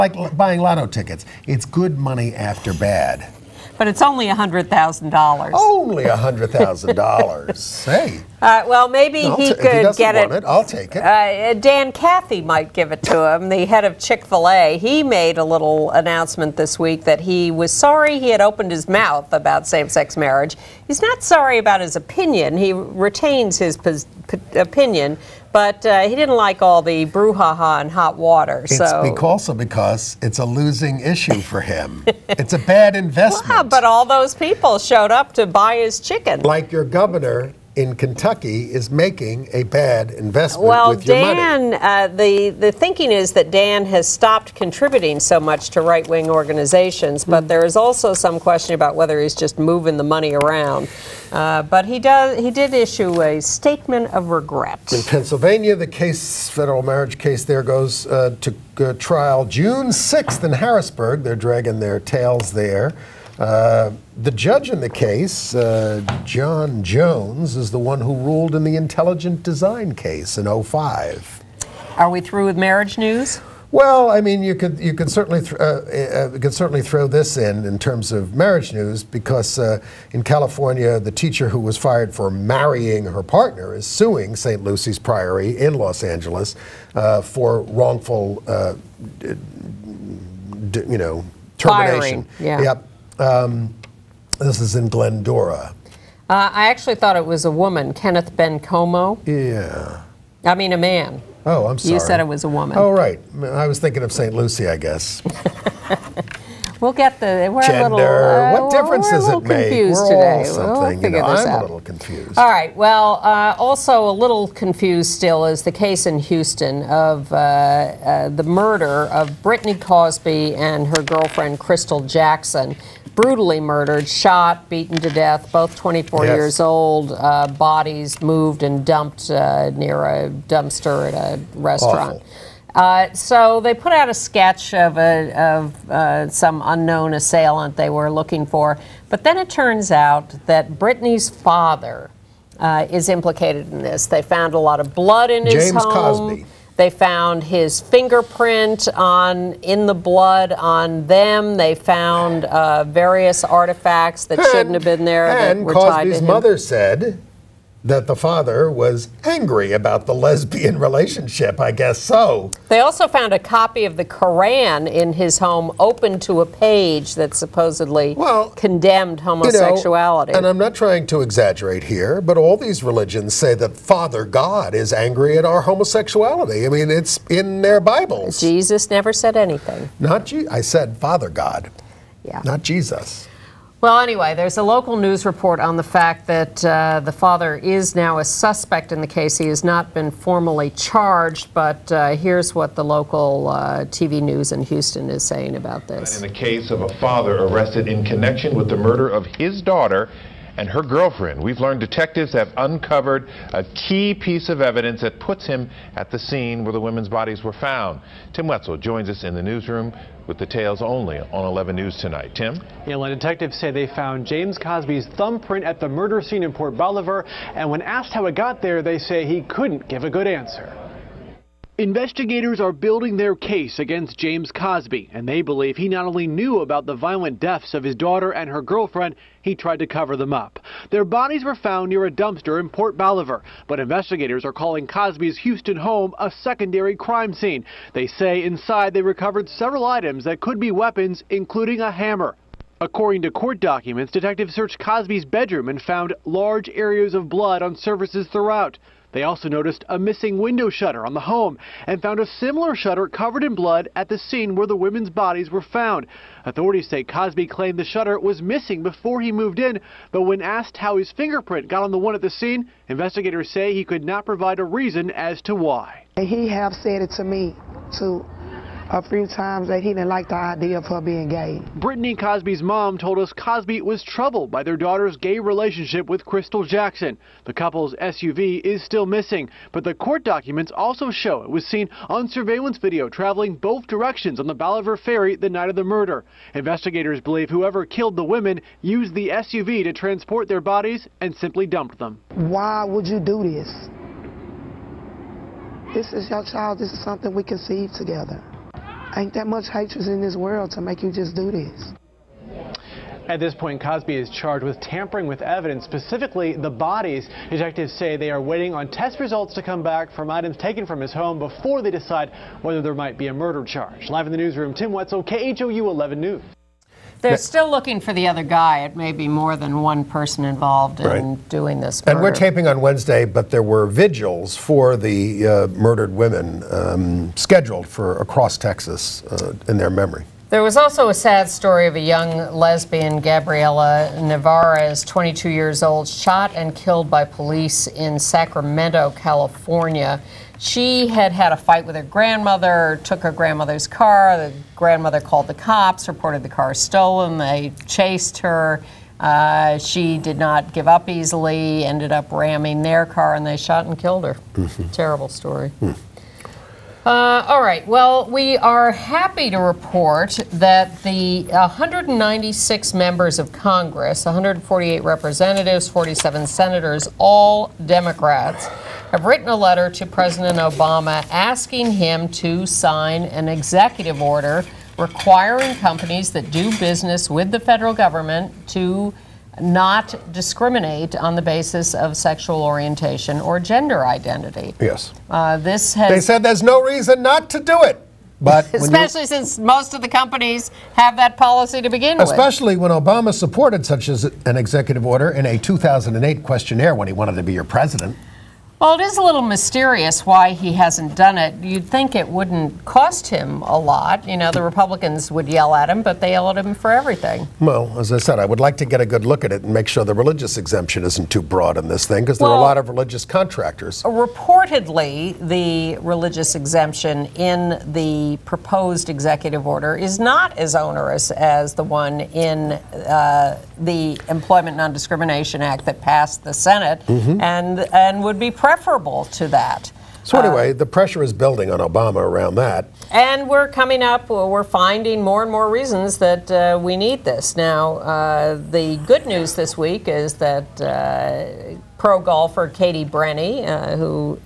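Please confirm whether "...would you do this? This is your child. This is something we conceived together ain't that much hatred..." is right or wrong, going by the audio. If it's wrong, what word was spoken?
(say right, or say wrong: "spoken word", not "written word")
right.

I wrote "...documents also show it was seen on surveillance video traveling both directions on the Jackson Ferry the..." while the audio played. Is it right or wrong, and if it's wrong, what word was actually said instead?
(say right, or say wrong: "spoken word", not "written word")
wrong: "Bolivar", not "Jackson".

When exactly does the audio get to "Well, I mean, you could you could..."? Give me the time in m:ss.
1:13.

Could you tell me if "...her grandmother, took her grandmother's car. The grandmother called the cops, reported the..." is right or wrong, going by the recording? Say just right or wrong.
right.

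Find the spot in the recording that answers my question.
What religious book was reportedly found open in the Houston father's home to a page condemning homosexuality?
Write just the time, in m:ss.
2:44.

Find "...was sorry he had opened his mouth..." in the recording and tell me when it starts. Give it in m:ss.
0:17.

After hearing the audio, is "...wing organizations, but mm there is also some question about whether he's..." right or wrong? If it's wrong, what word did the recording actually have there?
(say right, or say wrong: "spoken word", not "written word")
right.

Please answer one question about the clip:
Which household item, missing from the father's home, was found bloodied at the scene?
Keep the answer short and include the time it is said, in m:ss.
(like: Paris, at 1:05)
window shutter, at 4:10.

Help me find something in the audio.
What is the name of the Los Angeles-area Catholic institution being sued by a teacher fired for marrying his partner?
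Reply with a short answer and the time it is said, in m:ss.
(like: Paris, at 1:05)
St. Lucy's Priory, at 1:24.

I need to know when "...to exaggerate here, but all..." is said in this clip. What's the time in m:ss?
2:51.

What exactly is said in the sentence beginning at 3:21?
We've learned detectives have uncovered a key piece of evidence that puts him at the scene where the women's bodies were found.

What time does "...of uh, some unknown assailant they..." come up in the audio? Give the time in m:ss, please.
2:15.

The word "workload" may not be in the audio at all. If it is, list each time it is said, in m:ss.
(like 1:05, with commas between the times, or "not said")
not said.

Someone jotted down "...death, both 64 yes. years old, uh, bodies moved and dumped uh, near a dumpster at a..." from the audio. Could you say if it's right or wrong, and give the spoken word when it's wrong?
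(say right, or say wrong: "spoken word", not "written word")
wrong: "24", not "64".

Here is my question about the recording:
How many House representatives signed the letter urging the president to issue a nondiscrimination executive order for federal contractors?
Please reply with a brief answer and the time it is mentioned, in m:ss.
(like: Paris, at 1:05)
148, at 6:04.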